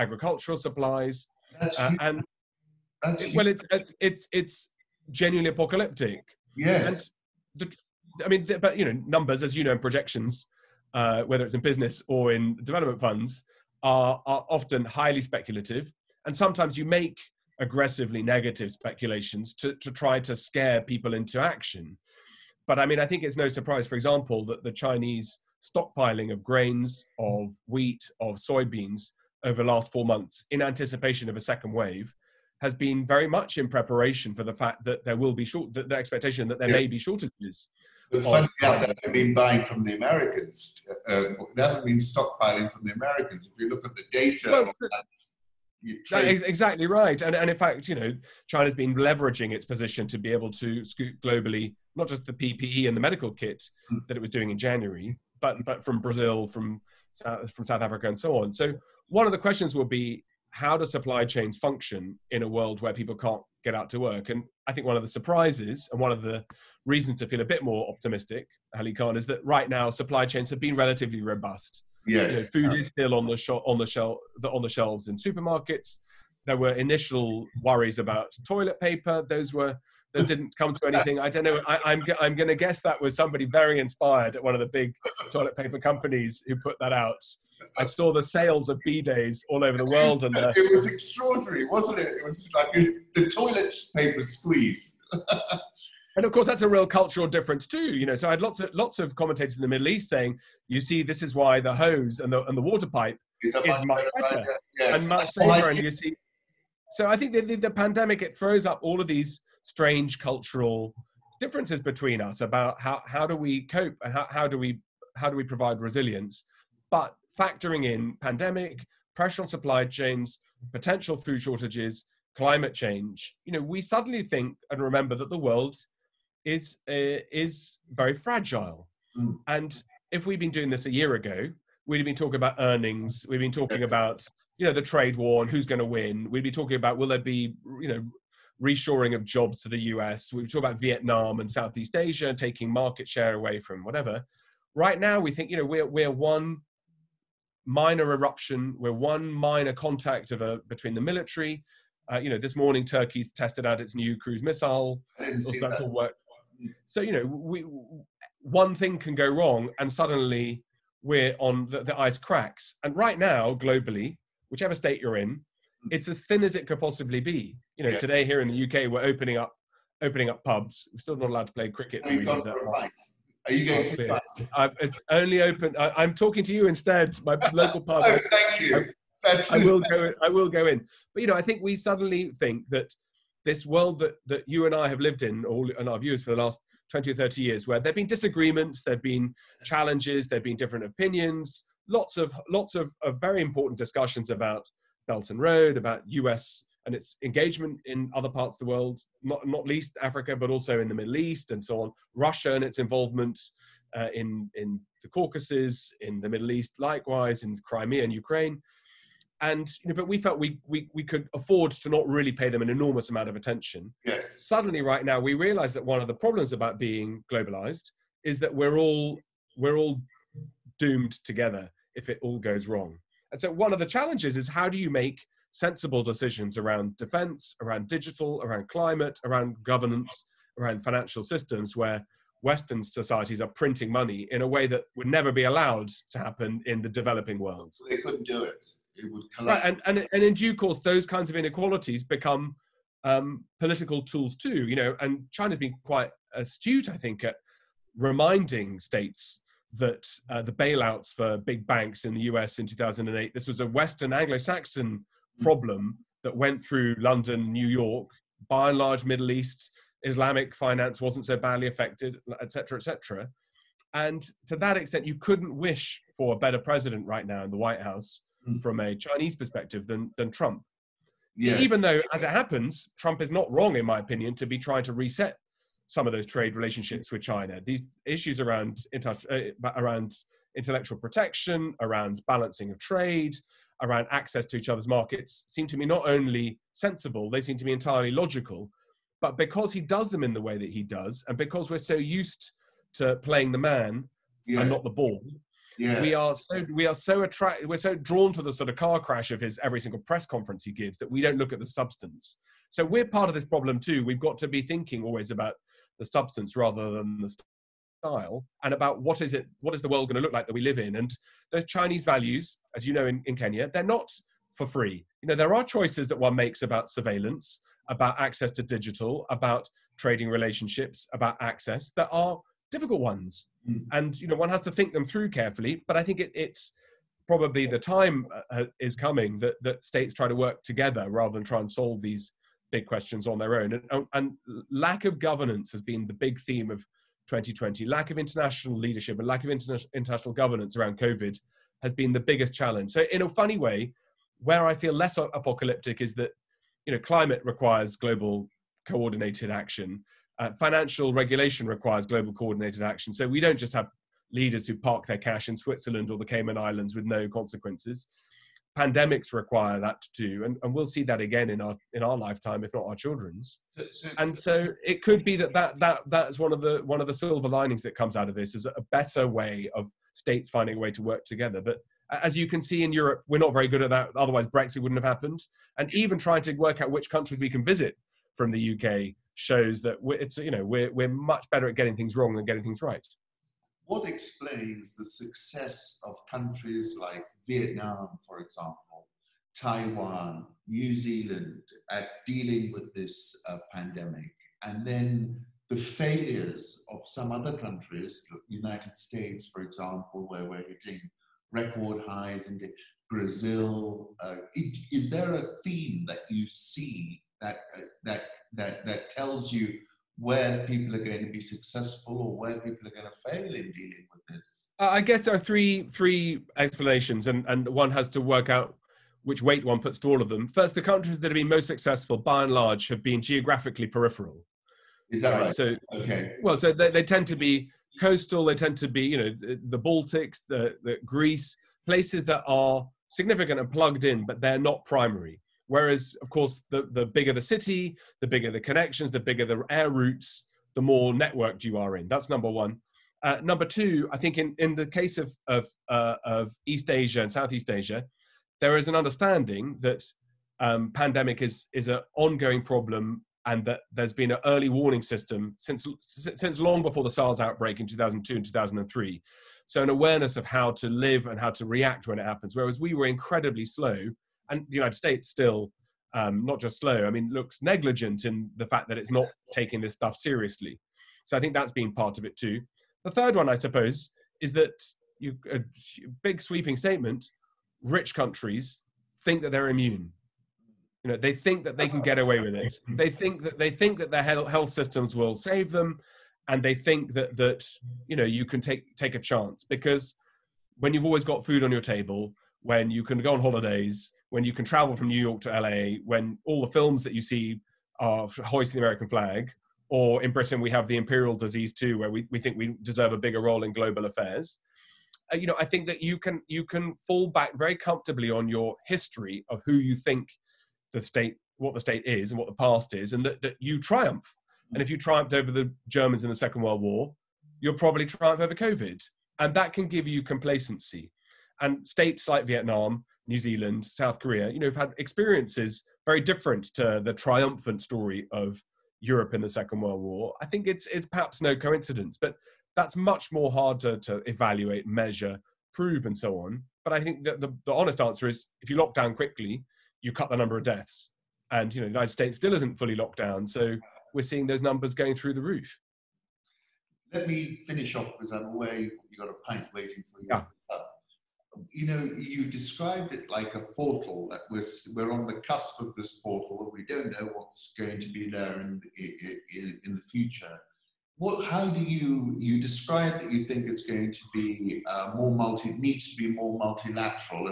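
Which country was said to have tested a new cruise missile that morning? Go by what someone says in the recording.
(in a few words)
Turkey.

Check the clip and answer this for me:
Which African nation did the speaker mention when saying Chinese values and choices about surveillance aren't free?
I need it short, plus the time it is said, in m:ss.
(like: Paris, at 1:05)
Kenya, at 5:13.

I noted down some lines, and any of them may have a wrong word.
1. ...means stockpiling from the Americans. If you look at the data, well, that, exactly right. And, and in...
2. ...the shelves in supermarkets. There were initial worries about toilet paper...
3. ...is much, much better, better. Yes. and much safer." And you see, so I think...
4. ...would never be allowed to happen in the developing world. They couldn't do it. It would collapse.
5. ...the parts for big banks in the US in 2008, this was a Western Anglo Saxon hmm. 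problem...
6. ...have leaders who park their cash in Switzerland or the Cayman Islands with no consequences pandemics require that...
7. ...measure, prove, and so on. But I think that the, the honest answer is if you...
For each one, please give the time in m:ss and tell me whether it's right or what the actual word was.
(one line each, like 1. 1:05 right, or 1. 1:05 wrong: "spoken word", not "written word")
1. 0:41 right
2. 1:14 right
3. 1:43 right
4. 3:54 right
5. 4:10 wrong: "bailouts", not "parts"
6. 5:53 right
7. 8:54 right.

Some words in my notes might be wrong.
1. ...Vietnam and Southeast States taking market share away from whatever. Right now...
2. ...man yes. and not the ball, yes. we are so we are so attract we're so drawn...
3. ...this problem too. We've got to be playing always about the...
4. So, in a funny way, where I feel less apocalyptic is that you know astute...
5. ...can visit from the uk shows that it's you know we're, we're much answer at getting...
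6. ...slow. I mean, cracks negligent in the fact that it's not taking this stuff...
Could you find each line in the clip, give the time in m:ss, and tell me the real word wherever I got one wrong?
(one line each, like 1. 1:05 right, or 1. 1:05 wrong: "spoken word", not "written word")
1. 2:20 wrong: "Asia", not "States"
2. 4:53 right
3. 5:03 wrong: "thinking", not "playing"
4. 5:42 wrong: "climate", not "astute"
5. 6:17 wrong: "better", not "answer"
6. 7:46 wrong: "looks", not "cracks".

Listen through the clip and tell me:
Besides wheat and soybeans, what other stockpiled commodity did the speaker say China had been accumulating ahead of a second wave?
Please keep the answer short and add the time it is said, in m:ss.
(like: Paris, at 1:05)
Grains, at 0:26.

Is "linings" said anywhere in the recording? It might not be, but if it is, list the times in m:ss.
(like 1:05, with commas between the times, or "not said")
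6:07.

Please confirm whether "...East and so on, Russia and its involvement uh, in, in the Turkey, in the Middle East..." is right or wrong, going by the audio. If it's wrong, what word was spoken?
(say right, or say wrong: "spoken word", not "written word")
wrong: "Caucasus", not "Turkey".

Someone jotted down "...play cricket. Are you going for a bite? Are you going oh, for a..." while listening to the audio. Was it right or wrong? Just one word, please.
right.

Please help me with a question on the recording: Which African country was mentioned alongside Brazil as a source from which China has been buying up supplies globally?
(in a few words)
South Africa.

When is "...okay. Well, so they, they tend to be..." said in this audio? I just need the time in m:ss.
7:05.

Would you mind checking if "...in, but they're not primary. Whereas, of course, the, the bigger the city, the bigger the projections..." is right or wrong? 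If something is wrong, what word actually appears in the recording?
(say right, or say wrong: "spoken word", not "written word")
wrong: "connections", not "projections".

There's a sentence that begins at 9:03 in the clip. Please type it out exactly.
So we're seeing those numbers going through the roof.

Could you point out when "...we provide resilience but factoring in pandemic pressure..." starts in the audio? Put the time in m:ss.
1:55.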